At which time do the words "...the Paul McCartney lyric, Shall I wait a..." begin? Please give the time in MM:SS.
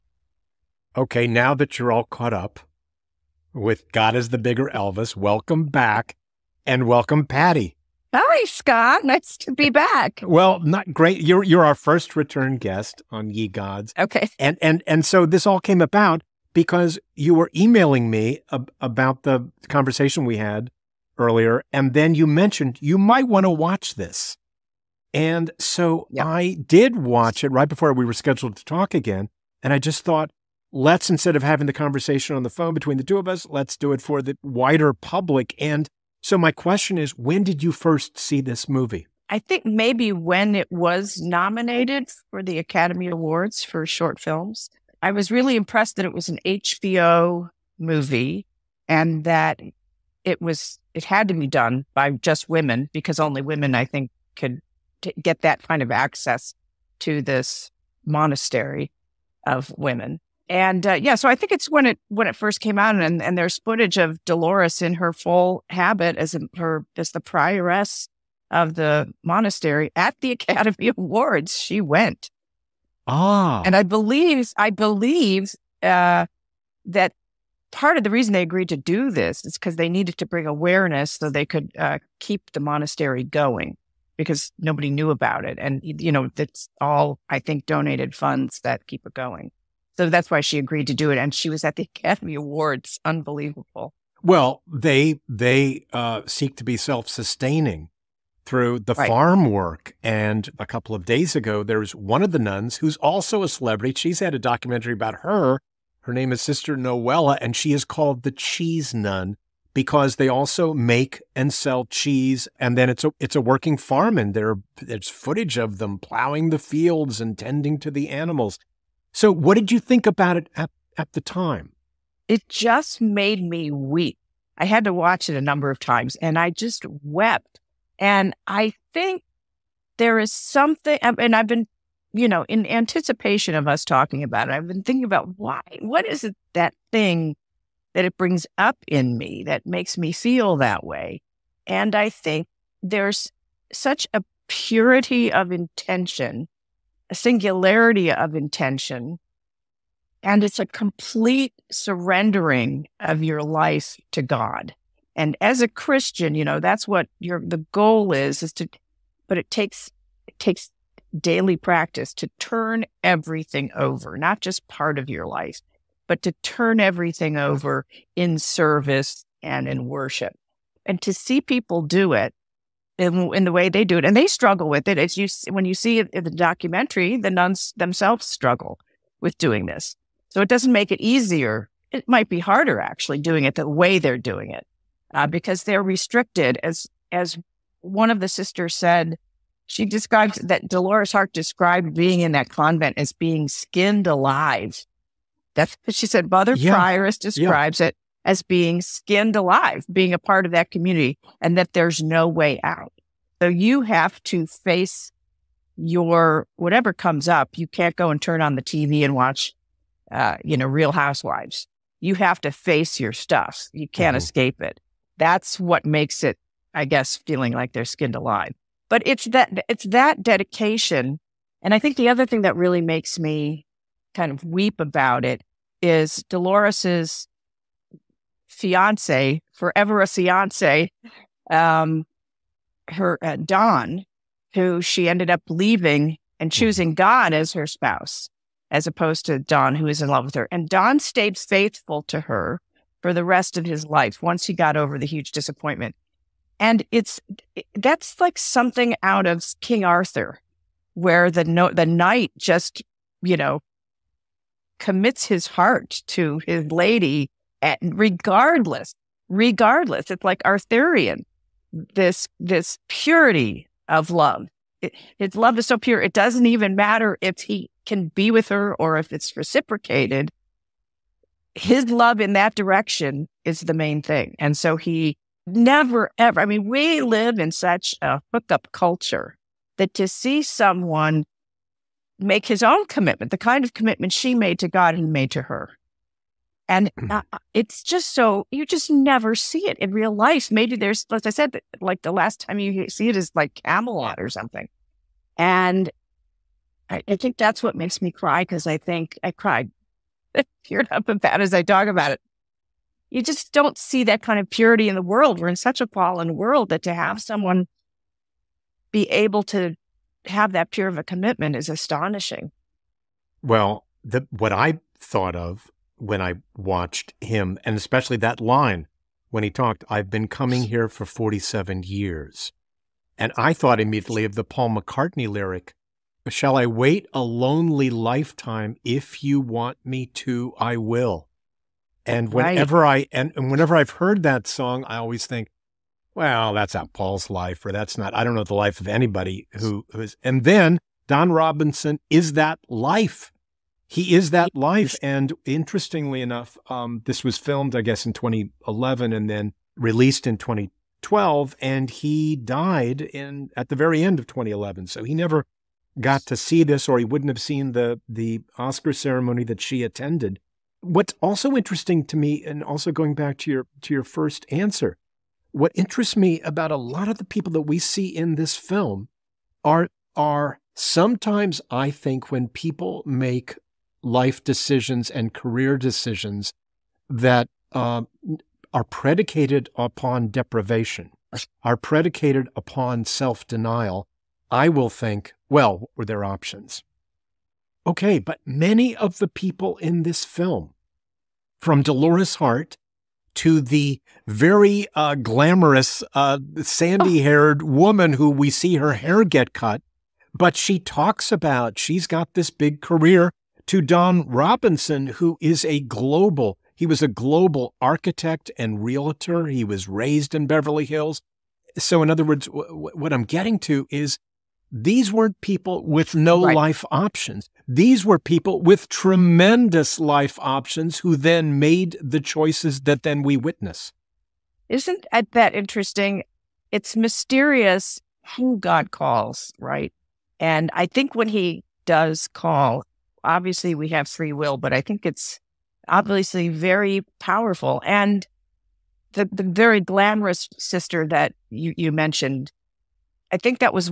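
05:24.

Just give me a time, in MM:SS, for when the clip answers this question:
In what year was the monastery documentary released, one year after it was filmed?
05:50.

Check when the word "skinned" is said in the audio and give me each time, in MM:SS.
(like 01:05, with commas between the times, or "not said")
03:13, 03:18, 03:37.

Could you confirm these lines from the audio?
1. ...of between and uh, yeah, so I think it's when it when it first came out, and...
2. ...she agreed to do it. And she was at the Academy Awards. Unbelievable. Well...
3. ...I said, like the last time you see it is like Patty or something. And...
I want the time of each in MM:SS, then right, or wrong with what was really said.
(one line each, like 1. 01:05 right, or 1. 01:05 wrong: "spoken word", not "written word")
1. 00:59 wrong: "women", not "between"
2. 01:30 right
3. 04:51 wrong: "Camelot", not "Patty".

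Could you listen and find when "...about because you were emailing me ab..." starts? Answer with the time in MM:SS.
00:15.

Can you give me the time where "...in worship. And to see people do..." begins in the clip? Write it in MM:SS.
02:49.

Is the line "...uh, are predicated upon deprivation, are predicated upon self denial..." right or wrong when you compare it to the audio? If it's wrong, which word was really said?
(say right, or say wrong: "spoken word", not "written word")
right.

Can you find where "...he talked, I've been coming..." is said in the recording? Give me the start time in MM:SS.
05:19.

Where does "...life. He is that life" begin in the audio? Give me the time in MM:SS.
05:42.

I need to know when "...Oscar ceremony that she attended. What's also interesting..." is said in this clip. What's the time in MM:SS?
05:58.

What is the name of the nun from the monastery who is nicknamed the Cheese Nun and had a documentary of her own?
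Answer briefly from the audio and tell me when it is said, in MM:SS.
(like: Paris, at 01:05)
Sister Noella, at 01:46.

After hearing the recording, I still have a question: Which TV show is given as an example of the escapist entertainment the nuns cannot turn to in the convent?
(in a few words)
Real Housewives.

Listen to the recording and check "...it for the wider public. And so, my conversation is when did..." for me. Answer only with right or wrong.
wrong.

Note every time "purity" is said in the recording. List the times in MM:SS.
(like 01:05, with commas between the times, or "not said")
02:24, 04:22, 05:04.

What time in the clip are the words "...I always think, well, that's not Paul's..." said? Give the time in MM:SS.
05:34.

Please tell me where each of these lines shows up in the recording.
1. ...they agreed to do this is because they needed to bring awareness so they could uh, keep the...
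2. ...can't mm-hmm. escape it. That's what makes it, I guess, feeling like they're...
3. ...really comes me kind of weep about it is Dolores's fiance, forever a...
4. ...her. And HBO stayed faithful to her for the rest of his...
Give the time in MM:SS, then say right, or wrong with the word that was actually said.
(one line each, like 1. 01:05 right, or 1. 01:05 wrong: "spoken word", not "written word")
1. 01:18 right
2. 03:33 right
3. 03:42 wrong: "makes", not "comes"
4. 04:00 wrong: "Don", not "HBO".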